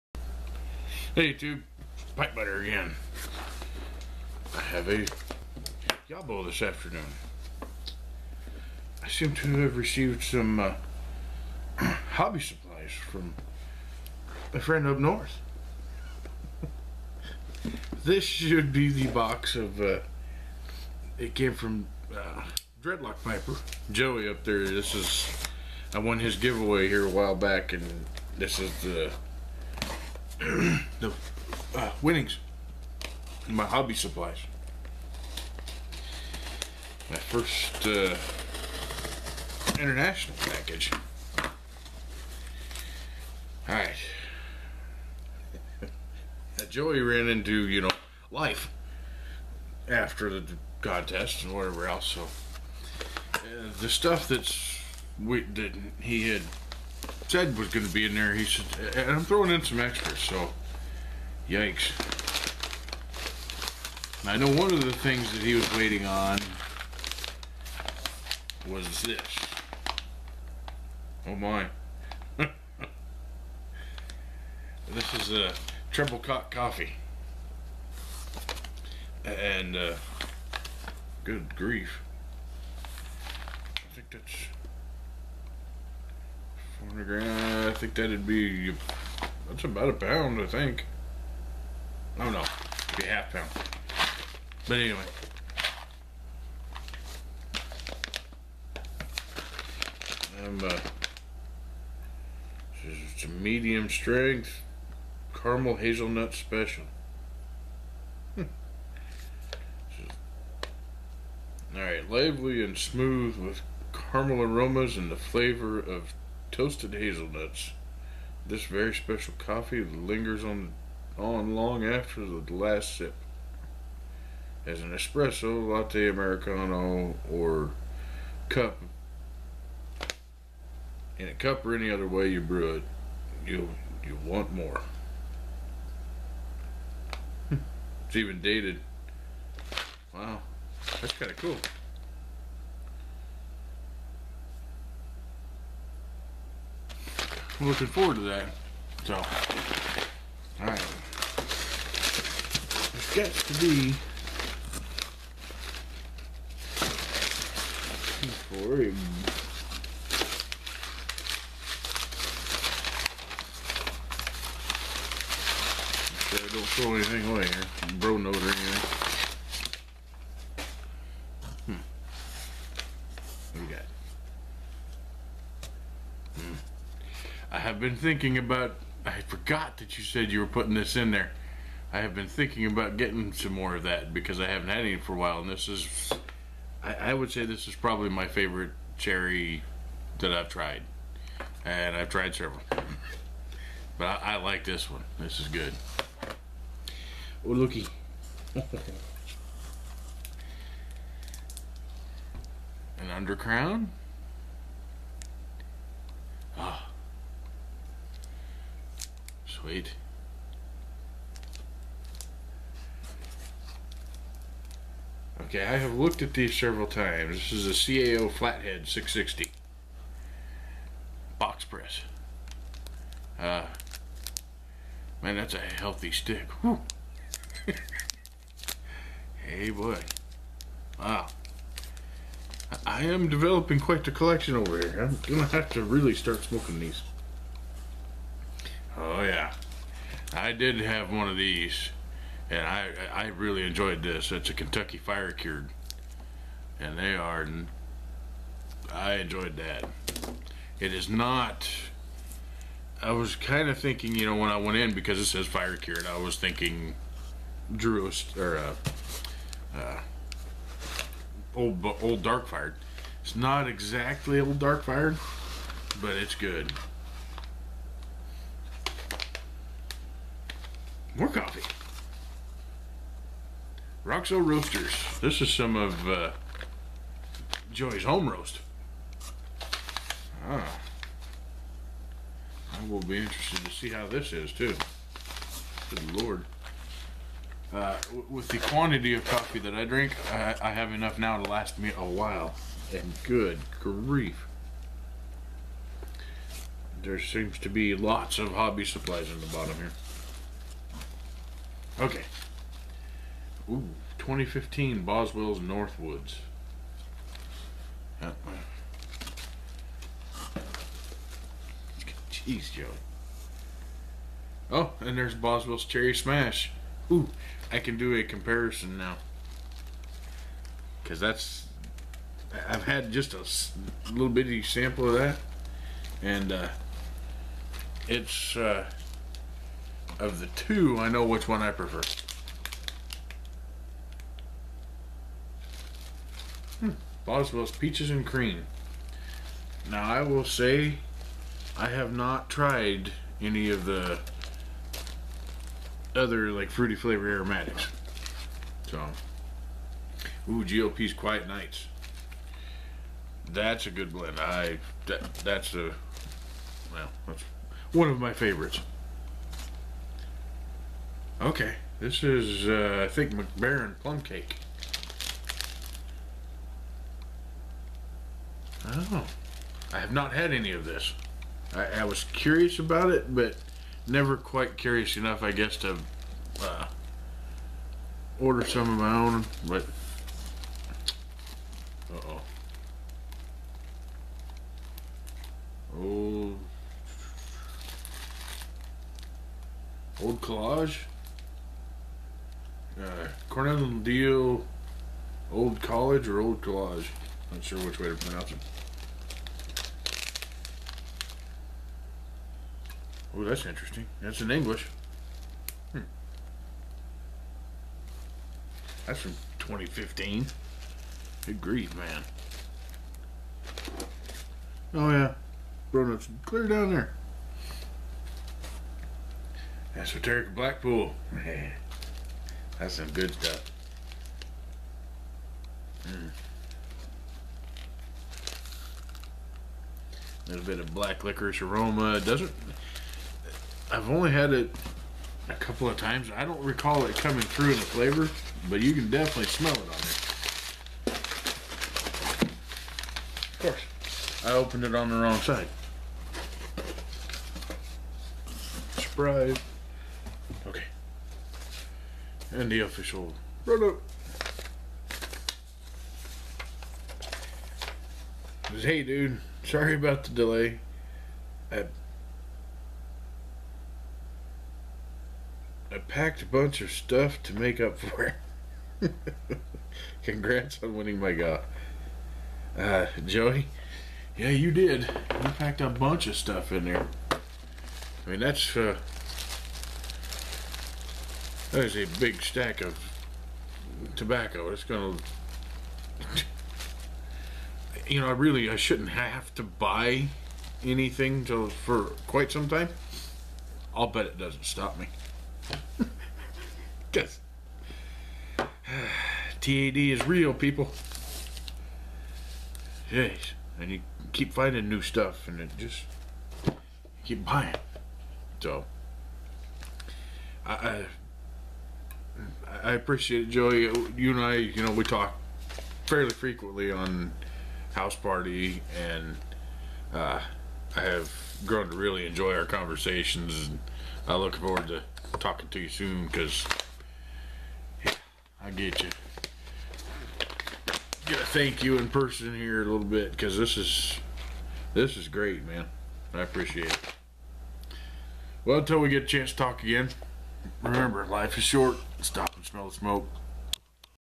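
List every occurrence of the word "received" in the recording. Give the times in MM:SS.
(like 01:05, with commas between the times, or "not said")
00:09.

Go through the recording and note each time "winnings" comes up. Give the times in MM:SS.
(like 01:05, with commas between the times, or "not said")
00:32, 07:50.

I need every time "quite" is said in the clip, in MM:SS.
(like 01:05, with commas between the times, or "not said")
03:53, 06:14, 08:12.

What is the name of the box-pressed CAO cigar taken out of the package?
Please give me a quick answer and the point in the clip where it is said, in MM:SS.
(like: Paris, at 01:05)
Flathead 660, at 03:38.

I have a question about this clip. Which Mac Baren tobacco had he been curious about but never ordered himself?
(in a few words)
Plum Cake.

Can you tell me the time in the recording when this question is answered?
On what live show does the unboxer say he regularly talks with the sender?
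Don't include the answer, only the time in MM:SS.
08:37.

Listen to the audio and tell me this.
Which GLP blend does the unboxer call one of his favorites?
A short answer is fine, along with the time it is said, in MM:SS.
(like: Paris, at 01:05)
Quiet Nights, at 05:51.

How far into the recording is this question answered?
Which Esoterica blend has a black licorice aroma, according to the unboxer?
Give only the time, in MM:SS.
07:00.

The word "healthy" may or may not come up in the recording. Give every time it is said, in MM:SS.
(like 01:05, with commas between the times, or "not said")
03:45.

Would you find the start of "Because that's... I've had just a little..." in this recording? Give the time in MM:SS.
05:21.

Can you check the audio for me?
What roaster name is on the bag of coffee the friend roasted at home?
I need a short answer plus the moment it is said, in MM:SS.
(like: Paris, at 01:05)
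Roxo Roasters, at 04:34.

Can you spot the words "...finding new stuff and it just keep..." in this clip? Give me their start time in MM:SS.
08:24.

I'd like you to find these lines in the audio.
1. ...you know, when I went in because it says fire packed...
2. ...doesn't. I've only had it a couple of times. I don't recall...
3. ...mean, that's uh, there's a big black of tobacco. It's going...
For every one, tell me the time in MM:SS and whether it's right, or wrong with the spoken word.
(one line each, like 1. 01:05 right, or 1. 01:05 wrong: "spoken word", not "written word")
1. 04:14 wrong: "cured", not "packed"
2. 07:12 right
3. 07:58 wrong: "stack", not "black".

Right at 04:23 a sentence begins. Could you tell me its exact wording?
It's not exactly old dark fired, but it's good.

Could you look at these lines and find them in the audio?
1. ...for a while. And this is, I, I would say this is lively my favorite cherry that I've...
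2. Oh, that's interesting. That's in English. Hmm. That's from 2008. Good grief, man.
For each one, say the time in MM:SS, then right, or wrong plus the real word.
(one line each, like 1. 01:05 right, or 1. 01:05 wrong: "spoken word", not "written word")
1. 03:04 wrong: "probably", not "lively"
2. 06:43 wrong: "2015", not "2008".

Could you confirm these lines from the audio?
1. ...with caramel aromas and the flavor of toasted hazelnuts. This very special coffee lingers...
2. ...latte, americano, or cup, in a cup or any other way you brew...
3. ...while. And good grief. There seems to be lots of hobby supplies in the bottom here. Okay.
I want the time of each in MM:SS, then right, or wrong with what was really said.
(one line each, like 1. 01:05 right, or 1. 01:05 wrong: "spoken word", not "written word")
1. 01:53 right
2. 02:05 right
3. 04:52 right.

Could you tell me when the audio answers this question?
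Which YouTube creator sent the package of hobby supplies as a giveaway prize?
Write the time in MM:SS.
00:22.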